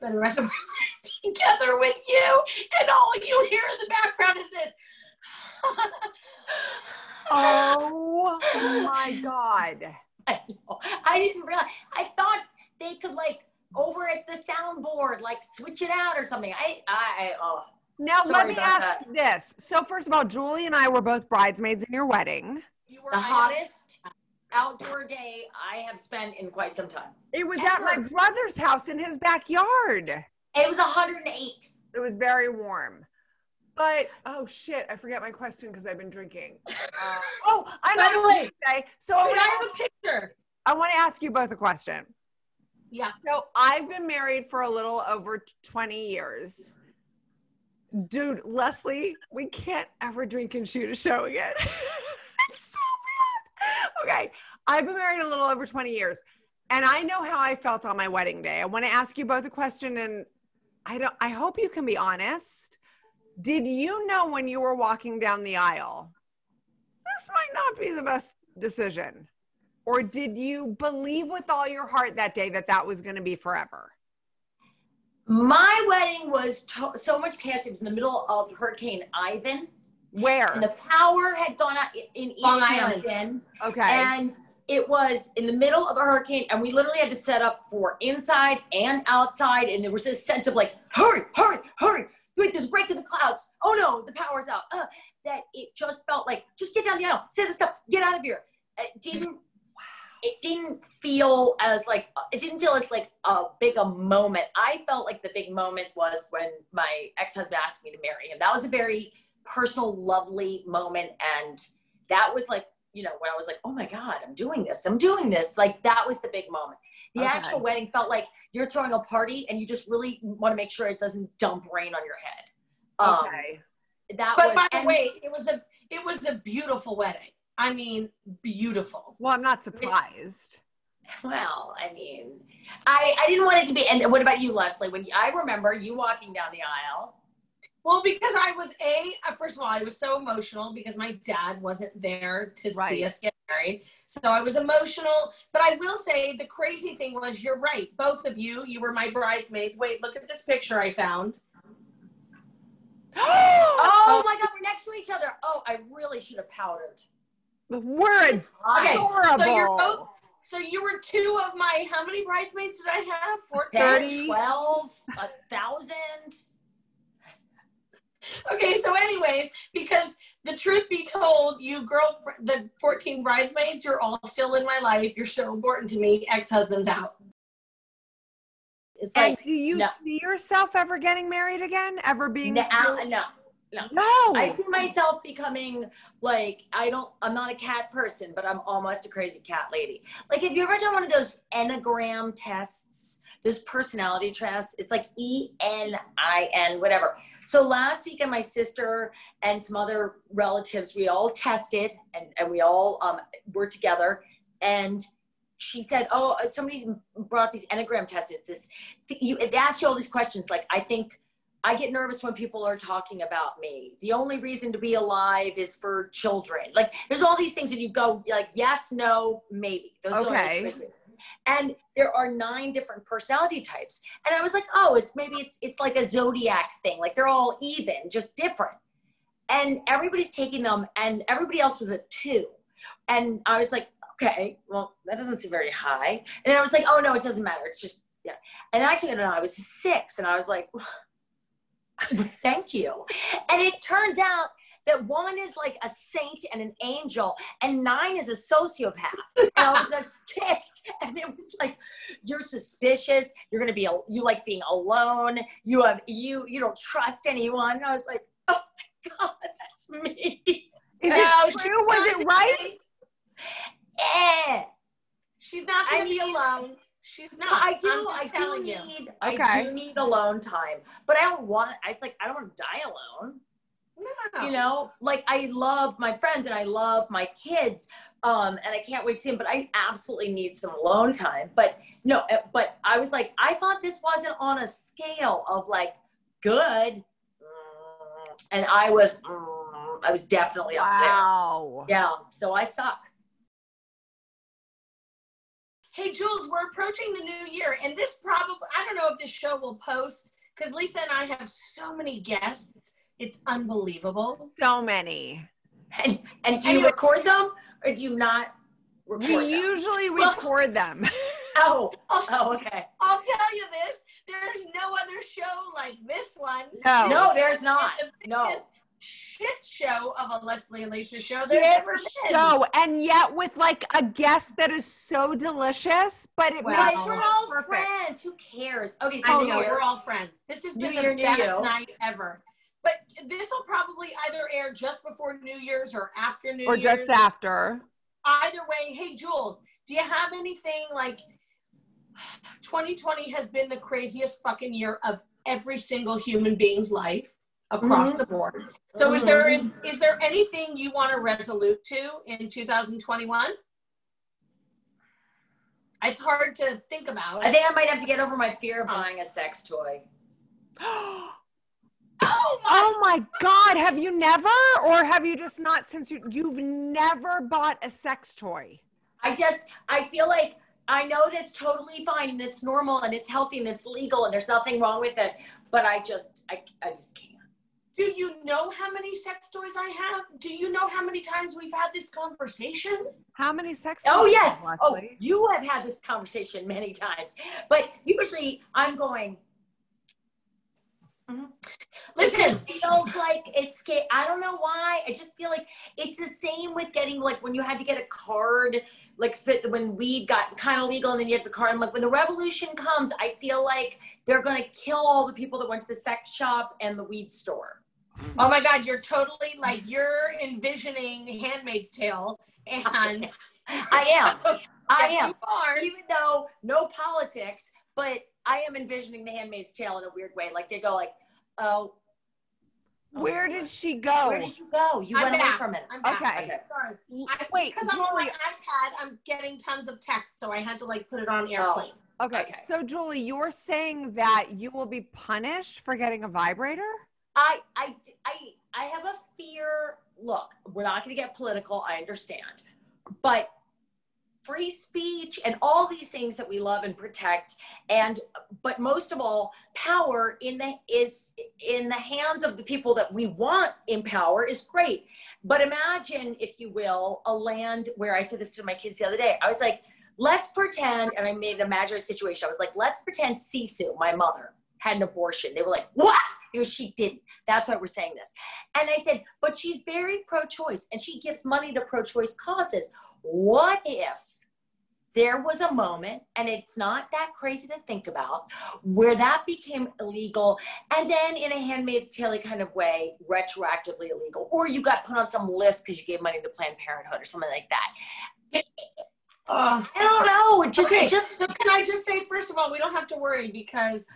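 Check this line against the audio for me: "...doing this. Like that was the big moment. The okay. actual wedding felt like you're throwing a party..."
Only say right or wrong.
right.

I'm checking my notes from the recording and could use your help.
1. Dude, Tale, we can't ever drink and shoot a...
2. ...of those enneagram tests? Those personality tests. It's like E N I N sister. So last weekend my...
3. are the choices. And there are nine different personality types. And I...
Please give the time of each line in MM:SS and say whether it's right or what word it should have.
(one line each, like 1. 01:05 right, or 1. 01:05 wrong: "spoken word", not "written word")
1. 00:48 wrong: "Lesley", not "Tale"
2. 03:11 wrong: "whatever", not "sister"
3. 03:40 right.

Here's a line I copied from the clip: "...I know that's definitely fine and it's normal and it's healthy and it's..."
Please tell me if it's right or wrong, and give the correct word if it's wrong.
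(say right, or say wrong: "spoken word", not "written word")
wrong: "totally", not "definitely".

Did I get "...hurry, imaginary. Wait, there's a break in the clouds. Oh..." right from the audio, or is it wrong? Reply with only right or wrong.
wrong.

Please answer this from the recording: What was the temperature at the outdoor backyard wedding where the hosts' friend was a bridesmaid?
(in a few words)
108.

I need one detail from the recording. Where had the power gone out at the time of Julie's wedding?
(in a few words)
East Long Island.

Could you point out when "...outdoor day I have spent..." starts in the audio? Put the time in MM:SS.
00:24.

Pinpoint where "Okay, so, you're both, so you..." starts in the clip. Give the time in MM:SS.
02:39.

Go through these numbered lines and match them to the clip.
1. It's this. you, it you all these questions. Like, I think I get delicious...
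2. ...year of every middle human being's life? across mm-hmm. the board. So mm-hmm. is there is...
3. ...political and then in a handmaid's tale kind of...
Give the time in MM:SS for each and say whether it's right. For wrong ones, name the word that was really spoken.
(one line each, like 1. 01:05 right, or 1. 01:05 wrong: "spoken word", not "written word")
1. 03:28 wrong: "nervous", not "delicious"
2. 05:44 wrong: "single", not "middle"
3. 07:59 wrong: "illegal", not "political".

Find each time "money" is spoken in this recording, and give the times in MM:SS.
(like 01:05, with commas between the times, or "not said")
07:51, 08:06.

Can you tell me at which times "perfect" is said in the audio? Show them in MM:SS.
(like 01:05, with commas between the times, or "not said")
05:27.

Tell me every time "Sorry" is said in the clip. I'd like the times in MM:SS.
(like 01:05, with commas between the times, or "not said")
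00:18, 07:06.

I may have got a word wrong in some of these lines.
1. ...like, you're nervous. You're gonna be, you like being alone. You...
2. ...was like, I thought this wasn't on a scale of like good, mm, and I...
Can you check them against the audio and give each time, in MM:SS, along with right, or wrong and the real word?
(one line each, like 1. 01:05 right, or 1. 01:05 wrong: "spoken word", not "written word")
1. 04:11 wrong: "suspicious", not "nervous"
2. 04:42 right.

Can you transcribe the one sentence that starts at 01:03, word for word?
Did you know when you were walking down the aisle?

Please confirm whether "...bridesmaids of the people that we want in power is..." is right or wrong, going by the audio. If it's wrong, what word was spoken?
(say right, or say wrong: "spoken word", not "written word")
wrong: "hands", not "bridesmaids".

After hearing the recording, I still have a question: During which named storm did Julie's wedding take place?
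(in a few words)
Hurricane Ivan.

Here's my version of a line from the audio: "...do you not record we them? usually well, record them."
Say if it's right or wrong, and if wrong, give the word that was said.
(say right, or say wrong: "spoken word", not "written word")
right.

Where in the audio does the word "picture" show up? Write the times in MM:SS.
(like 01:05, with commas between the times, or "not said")
00:39, 02:30.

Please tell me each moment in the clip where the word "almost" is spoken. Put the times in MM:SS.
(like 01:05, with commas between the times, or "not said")
03:08.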